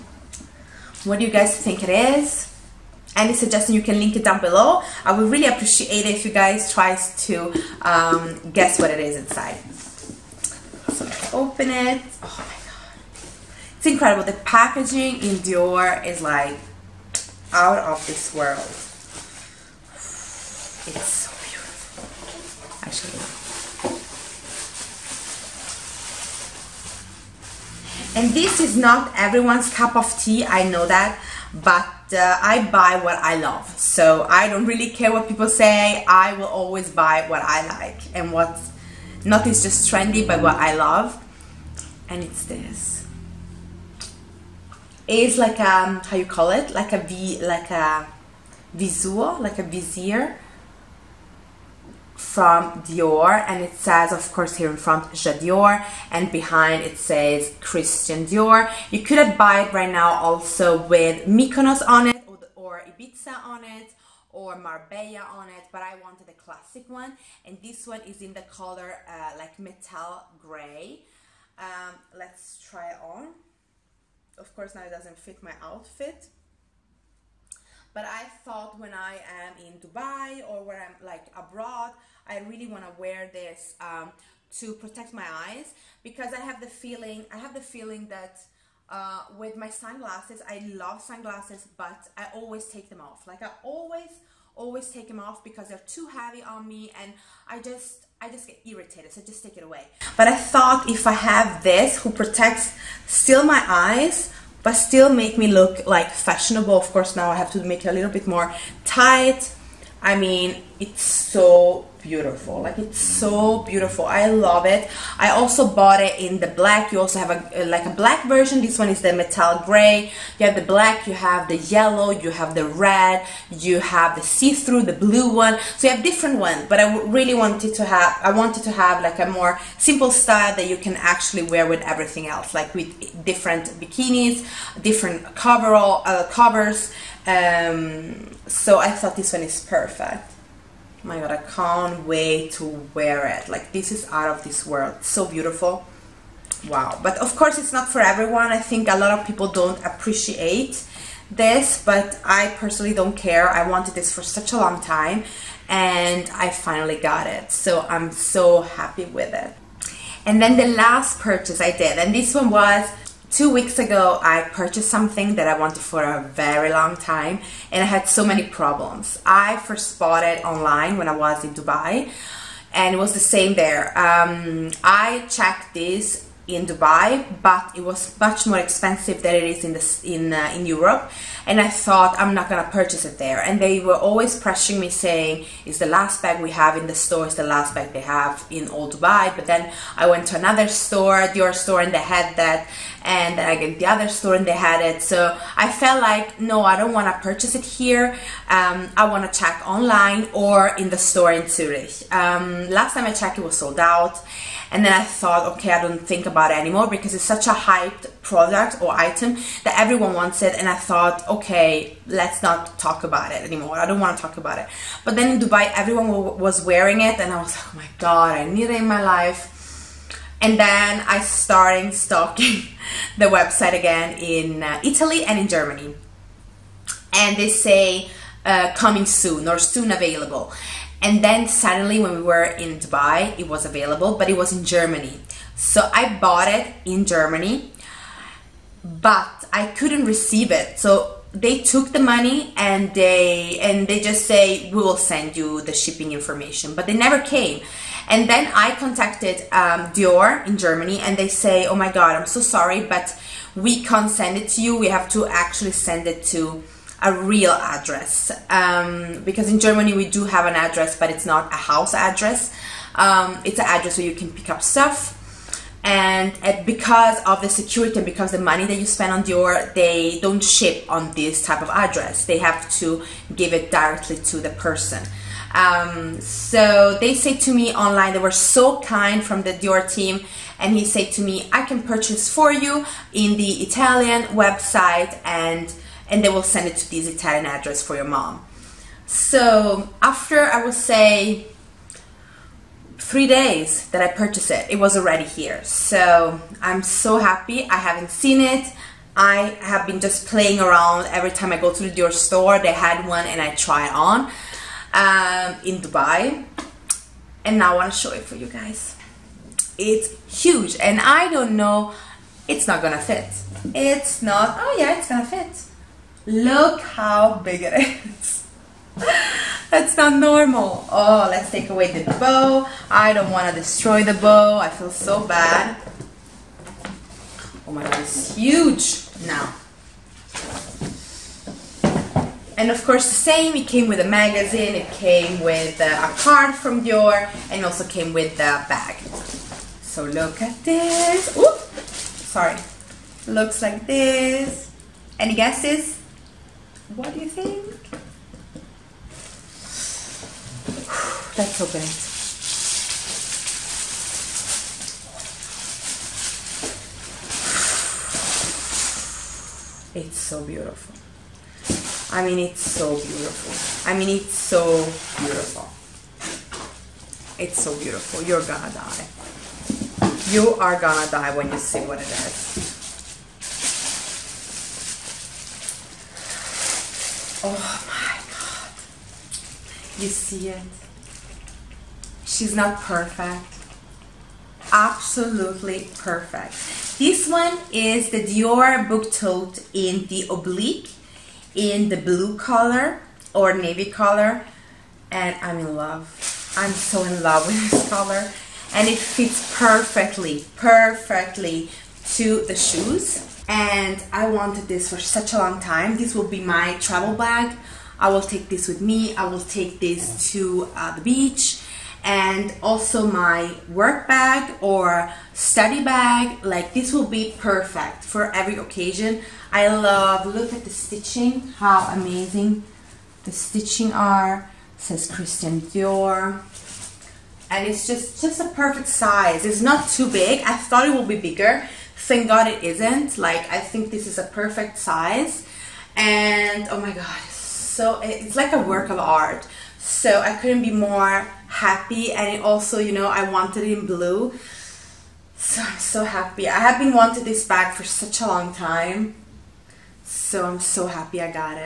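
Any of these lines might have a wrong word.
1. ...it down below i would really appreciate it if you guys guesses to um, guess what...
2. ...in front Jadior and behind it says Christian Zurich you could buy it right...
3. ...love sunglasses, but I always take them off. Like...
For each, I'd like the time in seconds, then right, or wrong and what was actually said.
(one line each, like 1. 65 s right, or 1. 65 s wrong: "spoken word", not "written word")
1. 4 s wrong: "tries", not "guesses"
2. 54 s wrong: "Dior", not "Zurich"
3. 90 s right.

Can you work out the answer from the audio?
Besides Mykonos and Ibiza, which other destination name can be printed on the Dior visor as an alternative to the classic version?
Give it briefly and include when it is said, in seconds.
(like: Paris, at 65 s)
Marbella, at 64 s.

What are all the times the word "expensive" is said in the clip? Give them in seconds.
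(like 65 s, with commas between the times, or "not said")
178 s.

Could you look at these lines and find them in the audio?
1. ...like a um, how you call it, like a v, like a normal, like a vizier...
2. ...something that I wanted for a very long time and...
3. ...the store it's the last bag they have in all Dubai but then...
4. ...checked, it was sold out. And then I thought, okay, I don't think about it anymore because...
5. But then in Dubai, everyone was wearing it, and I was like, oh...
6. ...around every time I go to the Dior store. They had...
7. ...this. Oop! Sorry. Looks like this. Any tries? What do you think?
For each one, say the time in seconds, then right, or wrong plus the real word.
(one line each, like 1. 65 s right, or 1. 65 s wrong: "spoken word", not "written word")
1. 45 s wrong: "visual", not "normal"
2. 164 s right
3. 186 s right
4. 203 s right
5. 215 s right
6. 300 s right
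7. 340 s wrong: "guesses", not "tries".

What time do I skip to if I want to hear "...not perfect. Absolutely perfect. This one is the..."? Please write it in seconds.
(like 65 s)
382 s.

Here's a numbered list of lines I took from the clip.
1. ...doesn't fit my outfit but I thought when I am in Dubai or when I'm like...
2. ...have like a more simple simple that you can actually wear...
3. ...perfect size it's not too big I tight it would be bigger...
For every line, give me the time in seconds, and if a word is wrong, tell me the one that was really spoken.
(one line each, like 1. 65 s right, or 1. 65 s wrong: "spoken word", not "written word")
1. 74 s right
2. 128 s wrong: "style", not "simple"
3. 428 s wrong: "thought", not "tight".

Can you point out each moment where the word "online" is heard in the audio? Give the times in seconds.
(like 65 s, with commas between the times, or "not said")
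170 s, 199 s, 277 s.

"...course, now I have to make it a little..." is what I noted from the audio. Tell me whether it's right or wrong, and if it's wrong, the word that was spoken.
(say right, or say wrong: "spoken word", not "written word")
right.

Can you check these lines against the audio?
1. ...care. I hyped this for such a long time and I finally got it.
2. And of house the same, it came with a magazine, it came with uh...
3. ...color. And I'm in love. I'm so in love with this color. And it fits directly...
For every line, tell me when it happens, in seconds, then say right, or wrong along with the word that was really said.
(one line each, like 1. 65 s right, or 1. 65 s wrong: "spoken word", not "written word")
1. 153 s wrong: "wanted", not "hyped"
2. 332 s wrong: "course", not "house"
3. 393 s wrong: "perfectly", not "directly".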